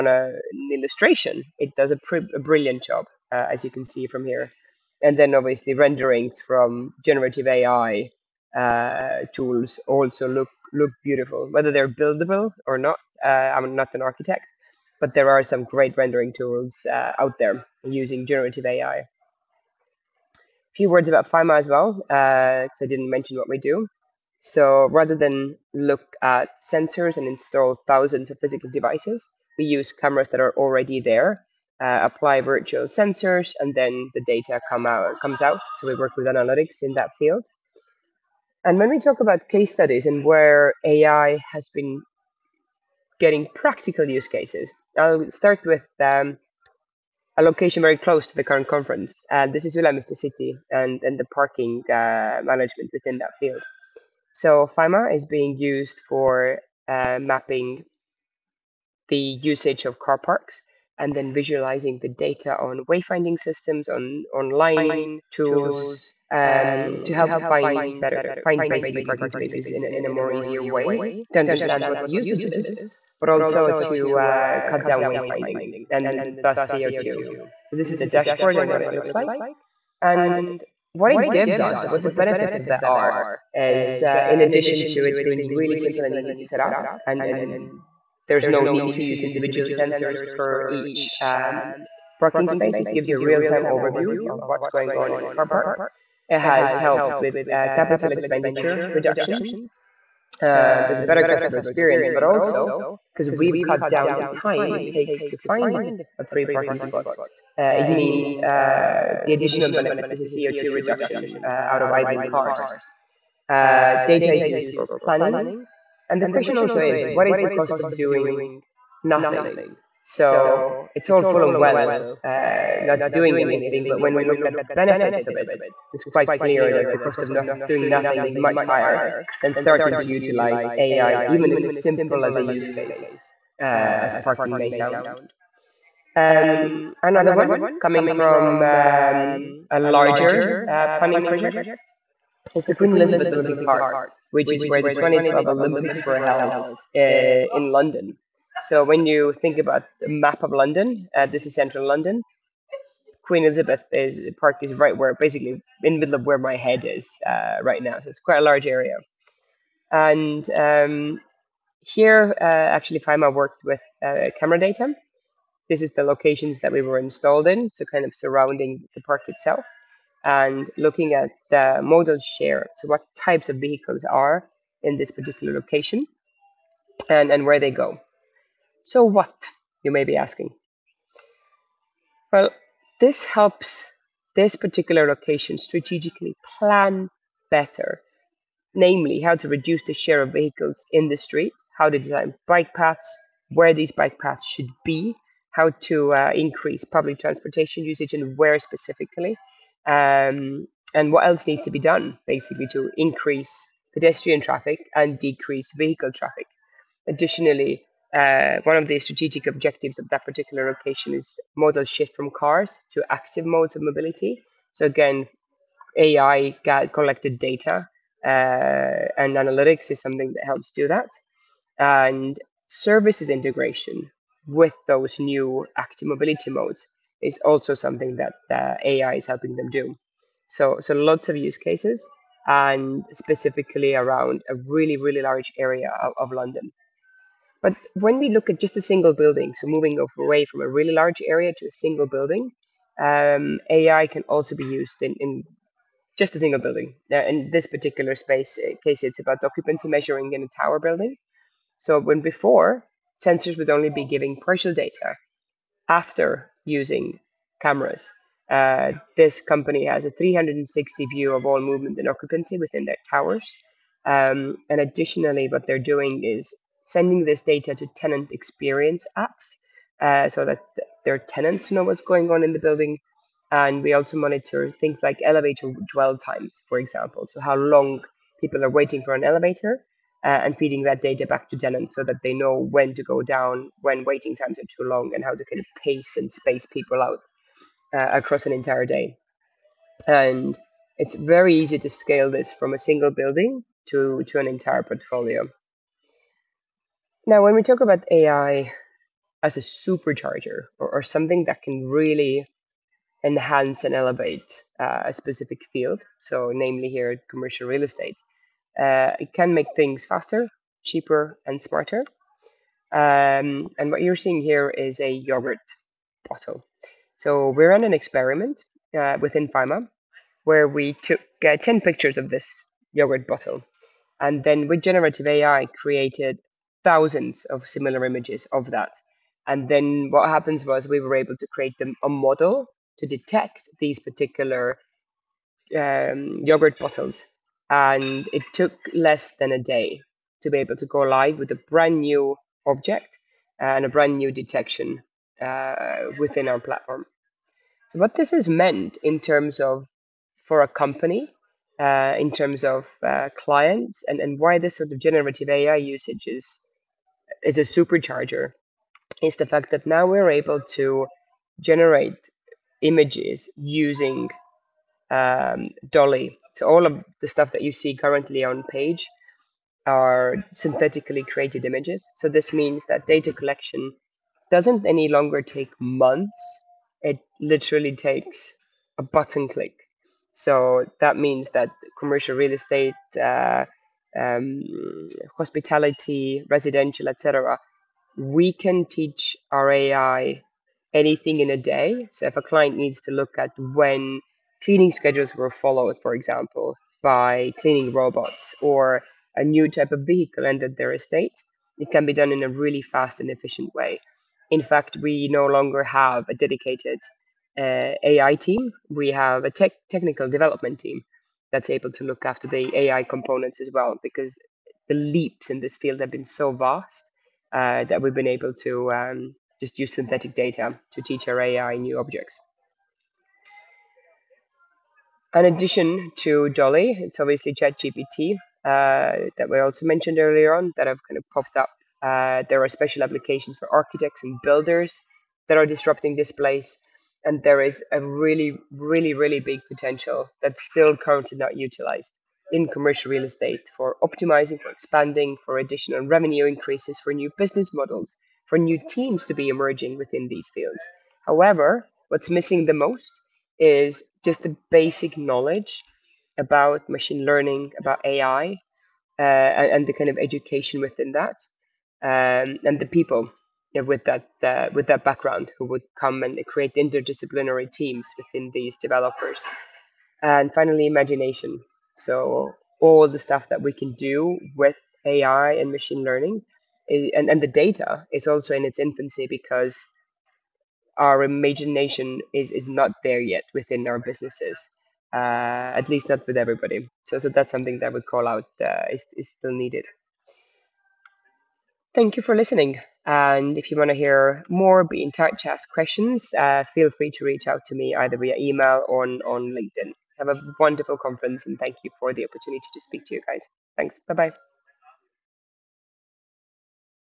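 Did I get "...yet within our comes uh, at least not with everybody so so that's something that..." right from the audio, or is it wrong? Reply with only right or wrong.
wrong.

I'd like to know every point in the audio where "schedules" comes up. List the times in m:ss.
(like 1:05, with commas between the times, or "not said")
6:34.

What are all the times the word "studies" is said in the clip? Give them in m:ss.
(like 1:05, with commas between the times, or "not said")
0:39.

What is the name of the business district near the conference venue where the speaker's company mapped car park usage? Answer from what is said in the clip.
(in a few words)
Ülemiste City.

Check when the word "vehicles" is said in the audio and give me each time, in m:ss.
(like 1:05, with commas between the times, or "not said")
2:53, 3:10, 3:25, 6:40.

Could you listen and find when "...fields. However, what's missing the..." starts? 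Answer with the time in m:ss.
7:30.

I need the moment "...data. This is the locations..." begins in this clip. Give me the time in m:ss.
2:44.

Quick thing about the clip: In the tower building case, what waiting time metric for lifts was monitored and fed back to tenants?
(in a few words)
elevator dwell times.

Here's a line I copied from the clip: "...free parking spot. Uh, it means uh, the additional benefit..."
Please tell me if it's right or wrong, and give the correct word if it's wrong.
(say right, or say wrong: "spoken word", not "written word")
right.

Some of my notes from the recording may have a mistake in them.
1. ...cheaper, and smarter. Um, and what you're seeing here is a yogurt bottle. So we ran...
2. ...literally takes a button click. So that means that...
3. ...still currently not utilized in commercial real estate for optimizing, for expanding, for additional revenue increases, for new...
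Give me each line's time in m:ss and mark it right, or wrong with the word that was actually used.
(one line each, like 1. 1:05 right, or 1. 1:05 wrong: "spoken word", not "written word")
1. 5:10 right
2. 6:17 right
3. 7:20 right.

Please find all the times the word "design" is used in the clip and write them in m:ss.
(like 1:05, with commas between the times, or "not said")
3:11.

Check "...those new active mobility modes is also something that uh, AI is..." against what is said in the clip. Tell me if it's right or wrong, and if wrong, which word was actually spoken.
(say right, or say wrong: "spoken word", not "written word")
right.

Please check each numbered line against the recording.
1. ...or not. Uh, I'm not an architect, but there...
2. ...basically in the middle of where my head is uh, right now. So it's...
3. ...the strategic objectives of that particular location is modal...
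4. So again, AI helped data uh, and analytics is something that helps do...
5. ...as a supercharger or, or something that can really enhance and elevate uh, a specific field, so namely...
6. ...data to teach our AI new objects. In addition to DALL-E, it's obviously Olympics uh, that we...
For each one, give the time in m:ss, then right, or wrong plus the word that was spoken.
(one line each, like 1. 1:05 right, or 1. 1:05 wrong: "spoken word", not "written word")
1. 0:12 right
2. 2:35 right
3. 3:28 right
4. 3:34 wrong: "collected", not "helped"
5. 4:59 right
6. 7:00 wrong: "ChatGPT", not "Olympics".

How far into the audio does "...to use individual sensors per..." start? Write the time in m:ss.
1:28.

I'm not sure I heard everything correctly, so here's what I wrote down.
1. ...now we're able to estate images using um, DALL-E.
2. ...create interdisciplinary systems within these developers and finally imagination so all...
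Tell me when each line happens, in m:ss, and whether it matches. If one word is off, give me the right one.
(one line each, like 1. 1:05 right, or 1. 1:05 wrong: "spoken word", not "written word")
1. 5:59 wrong: "generate", not "estate"
2. 7:46 wrong: "teams", not "systems".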